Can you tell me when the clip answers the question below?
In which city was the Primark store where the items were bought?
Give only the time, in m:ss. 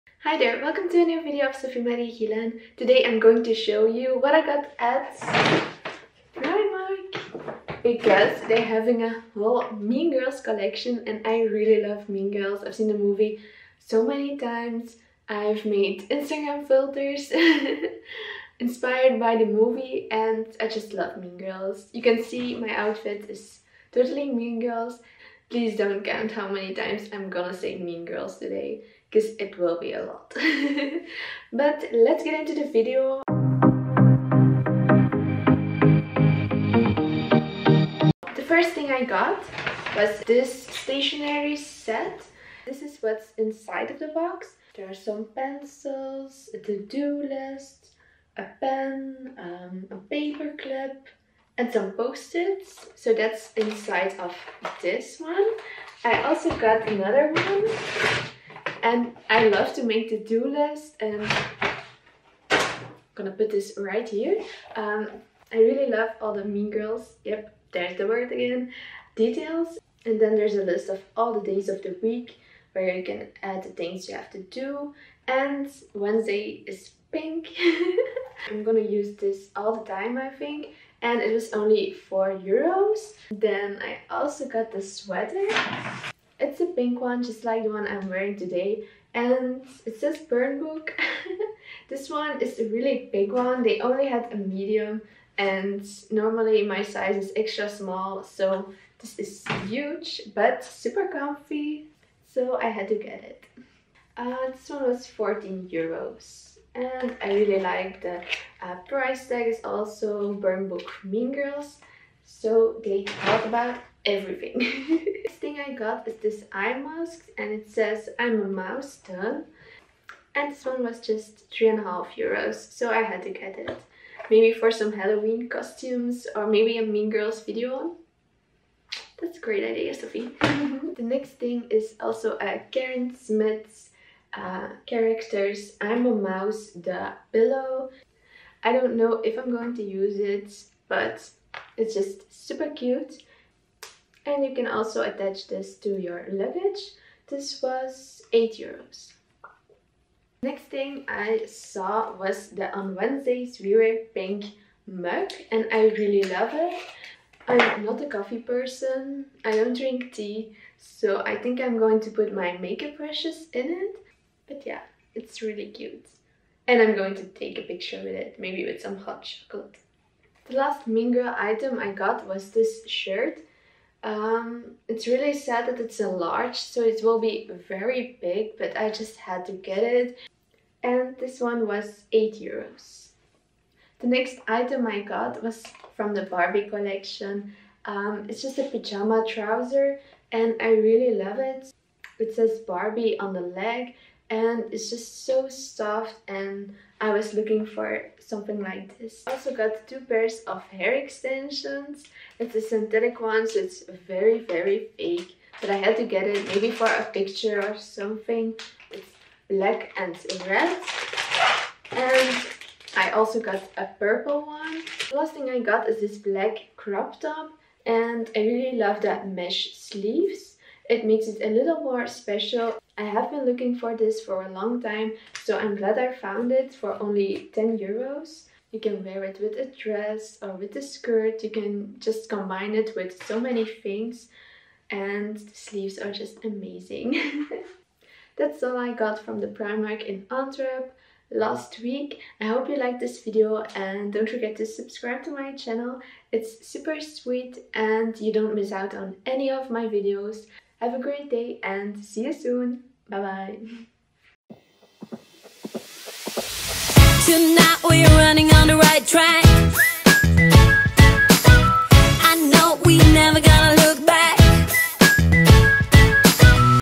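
4:00.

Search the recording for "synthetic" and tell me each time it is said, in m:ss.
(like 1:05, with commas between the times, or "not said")
3:22.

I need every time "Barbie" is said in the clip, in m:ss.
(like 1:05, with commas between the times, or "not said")
3:06, 3:12.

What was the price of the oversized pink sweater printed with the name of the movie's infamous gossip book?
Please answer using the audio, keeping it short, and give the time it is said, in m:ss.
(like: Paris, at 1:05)
14 euros, at 1:45.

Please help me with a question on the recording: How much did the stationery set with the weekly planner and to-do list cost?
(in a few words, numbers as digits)
4 euros.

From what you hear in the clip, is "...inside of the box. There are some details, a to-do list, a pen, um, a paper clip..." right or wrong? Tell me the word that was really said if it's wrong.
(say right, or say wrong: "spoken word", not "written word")
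wrong: "pencils", not "details".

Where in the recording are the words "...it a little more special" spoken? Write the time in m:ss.
3:41.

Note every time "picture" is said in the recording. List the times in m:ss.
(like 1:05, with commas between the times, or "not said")
2:47, 3:27.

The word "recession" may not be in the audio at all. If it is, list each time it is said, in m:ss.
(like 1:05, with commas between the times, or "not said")
not said.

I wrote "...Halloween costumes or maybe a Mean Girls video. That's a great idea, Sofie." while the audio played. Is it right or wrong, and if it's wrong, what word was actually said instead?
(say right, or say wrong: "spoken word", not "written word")
right.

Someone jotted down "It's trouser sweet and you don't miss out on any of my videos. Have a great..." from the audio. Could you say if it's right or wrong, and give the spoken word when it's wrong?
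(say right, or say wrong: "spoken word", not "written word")
wrong: "super", not "trouser".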